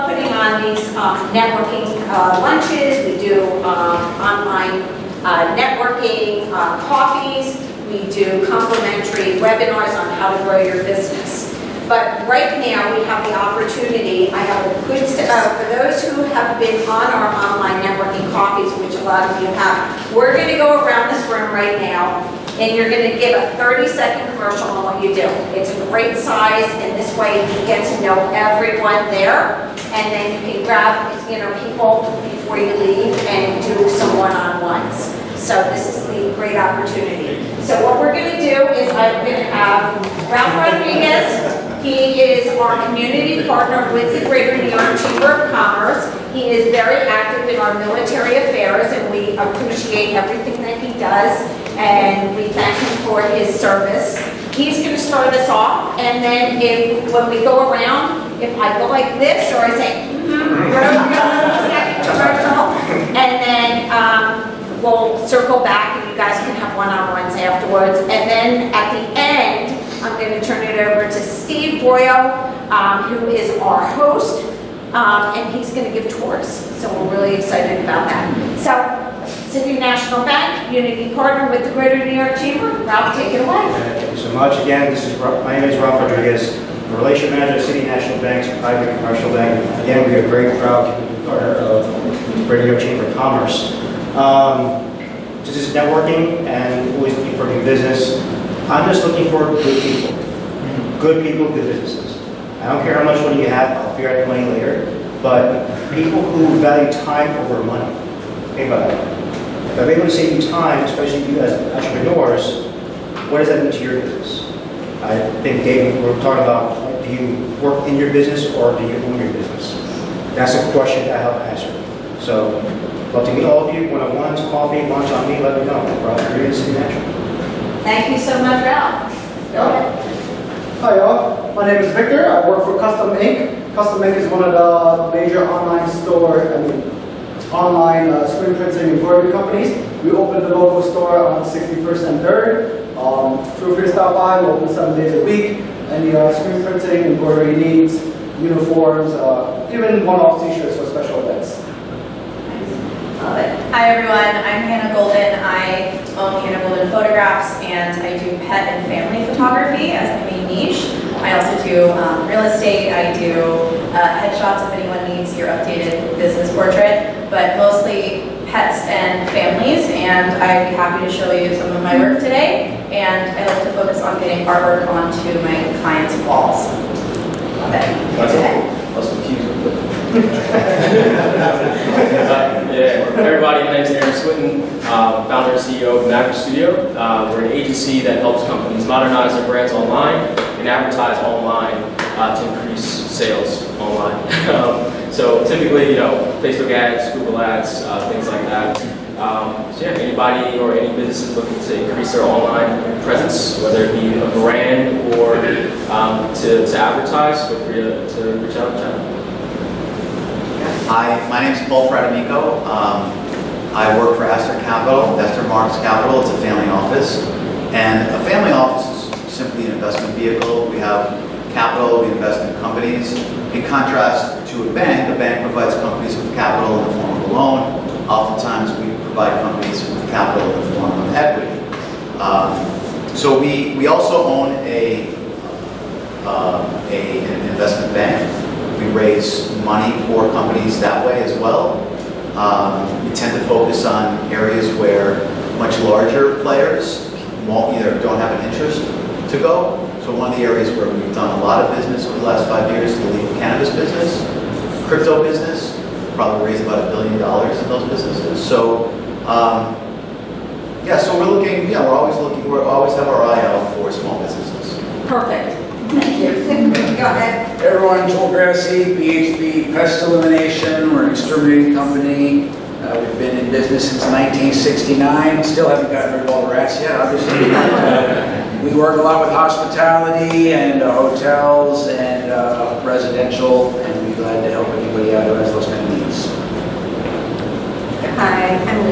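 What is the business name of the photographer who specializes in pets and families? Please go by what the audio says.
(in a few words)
Hand-woven photographs.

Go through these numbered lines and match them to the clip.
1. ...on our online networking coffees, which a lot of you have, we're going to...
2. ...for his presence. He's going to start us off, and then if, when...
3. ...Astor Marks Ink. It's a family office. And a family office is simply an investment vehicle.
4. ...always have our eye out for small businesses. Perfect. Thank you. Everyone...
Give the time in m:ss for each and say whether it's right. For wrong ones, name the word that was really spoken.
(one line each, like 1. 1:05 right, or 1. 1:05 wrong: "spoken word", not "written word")
1. 0:16 right
2. 0:53 wrong: "service", not "presence"
3. 3:35 wrong: "Capital", not "Ink"
4. 4:22 right.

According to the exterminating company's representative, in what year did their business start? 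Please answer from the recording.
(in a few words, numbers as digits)
1969.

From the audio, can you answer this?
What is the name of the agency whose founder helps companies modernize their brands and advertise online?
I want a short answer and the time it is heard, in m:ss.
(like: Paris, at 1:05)
Maverick Studio, at 3:06.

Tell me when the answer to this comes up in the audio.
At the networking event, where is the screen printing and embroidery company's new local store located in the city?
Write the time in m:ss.
2:21.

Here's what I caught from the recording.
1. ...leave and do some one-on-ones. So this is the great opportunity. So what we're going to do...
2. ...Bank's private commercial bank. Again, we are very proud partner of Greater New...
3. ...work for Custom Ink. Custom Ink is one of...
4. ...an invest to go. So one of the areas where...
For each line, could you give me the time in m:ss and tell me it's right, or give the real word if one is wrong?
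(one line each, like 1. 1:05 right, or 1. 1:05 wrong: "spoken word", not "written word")
1. 0:32 right
2. 1:28 right
3. 2:12 right
4. 4:08 wrong: "interest", not "invest".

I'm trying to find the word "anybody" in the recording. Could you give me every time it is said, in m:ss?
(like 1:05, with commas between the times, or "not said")
3:19, 4:44.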